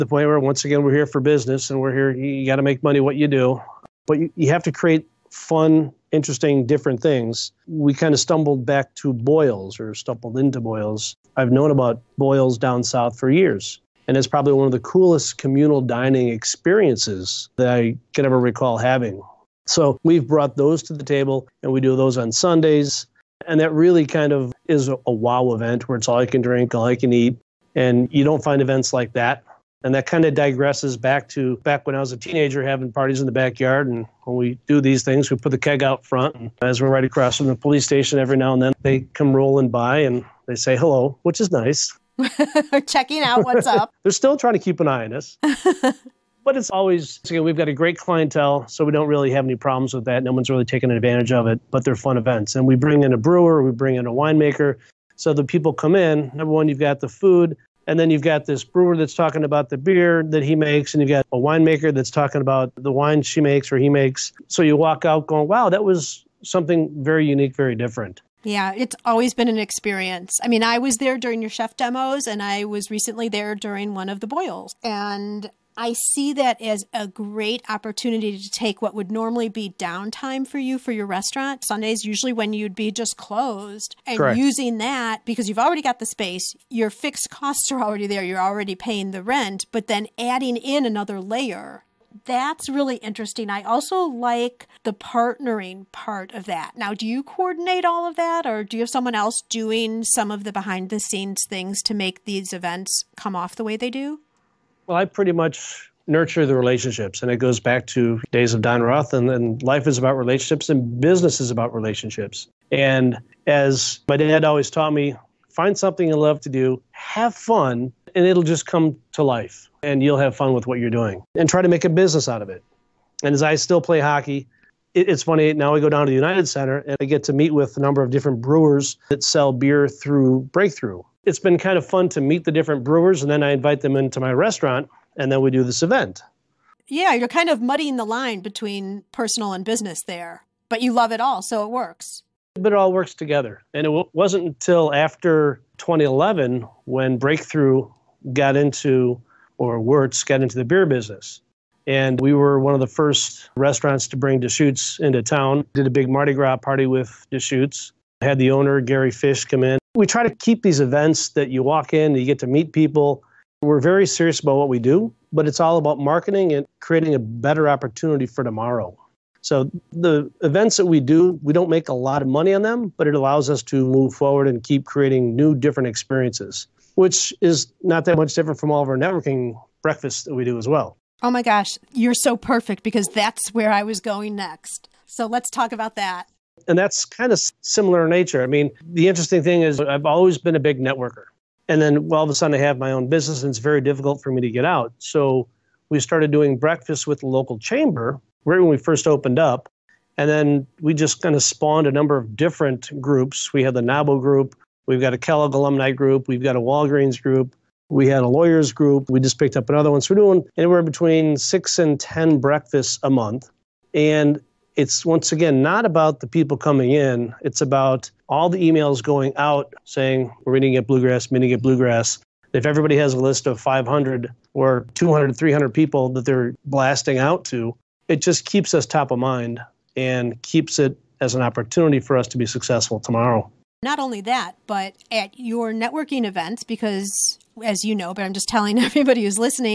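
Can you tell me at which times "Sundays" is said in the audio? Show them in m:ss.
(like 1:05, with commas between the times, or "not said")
0:22, 1:21.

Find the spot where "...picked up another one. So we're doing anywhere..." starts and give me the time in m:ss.
3:29.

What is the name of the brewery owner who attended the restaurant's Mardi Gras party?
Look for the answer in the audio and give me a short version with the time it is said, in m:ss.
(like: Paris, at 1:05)
Gary Fish, at 2:38.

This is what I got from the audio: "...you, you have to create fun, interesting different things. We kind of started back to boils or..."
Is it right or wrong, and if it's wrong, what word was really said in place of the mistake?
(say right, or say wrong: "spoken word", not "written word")
wrong: "stumbled", not "started".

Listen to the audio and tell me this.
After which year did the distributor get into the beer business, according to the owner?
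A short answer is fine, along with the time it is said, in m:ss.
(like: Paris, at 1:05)
2011, at 2:25.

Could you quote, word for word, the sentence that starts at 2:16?
Yeah, you're kind of muddying the line between personal and business there, but you love it all, so it works.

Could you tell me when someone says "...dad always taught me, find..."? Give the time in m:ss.
1:54.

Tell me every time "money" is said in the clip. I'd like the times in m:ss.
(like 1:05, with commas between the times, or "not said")
0:02, 2:52.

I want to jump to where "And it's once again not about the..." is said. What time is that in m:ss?
3:33.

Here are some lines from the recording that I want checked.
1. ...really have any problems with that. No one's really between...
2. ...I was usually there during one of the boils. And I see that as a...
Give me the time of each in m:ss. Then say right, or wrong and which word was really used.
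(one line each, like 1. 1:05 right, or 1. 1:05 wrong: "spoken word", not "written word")
1. 0:49 wrong: "taken", not "between"
2. 1:12 wrong: "recently", not "usually".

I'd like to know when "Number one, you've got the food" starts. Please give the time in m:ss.
0:56.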